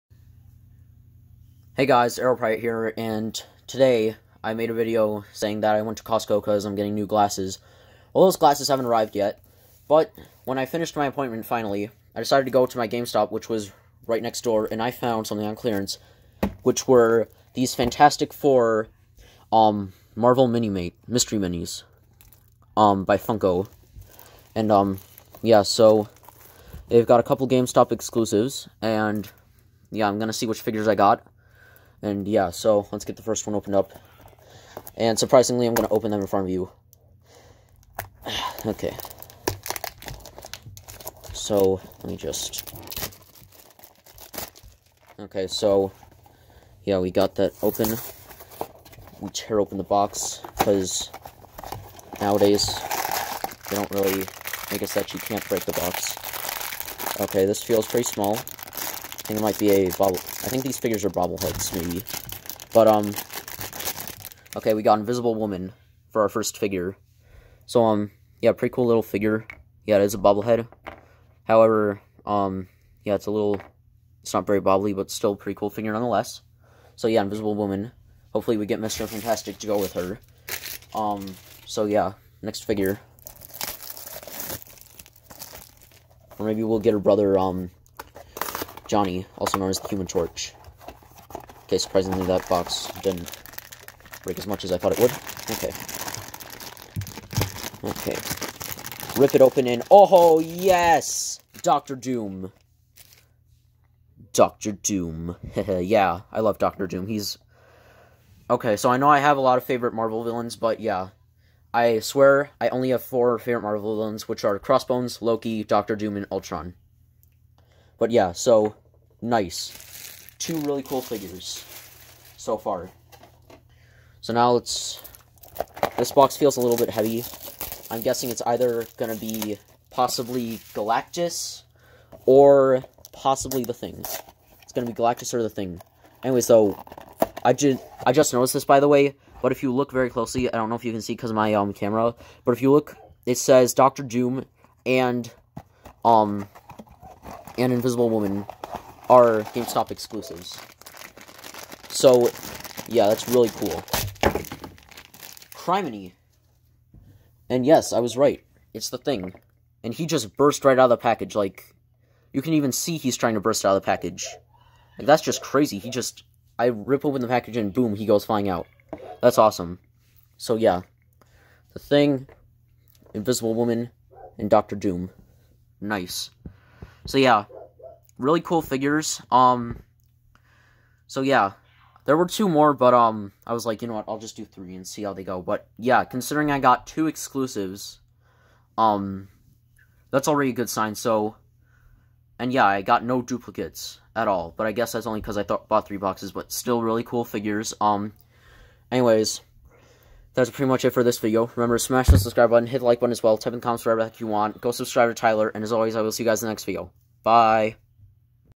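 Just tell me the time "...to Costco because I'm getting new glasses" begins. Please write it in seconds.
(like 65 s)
5 s.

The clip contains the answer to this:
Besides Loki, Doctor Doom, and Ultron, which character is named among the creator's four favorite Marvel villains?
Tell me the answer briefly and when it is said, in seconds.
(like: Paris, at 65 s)
Crossbones, at 114 s.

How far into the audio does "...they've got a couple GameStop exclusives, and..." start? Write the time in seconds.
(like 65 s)
26 s.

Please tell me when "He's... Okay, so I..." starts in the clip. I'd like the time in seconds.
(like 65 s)
107 s.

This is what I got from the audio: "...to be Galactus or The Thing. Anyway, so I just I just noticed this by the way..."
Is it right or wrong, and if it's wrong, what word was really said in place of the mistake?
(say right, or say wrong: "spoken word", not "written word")
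right.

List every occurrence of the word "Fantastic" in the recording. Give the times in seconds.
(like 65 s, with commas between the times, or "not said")
17 s, 79 s.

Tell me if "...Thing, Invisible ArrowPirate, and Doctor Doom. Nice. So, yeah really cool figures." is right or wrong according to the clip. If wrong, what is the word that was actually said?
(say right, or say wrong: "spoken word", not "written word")
wrong: "Woman", not "ArrowPirate".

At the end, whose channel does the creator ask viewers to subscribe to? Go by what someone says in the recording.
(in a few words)
Tyler.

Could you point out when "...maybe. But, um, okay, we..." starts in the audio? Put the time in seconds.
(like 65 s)
61 s.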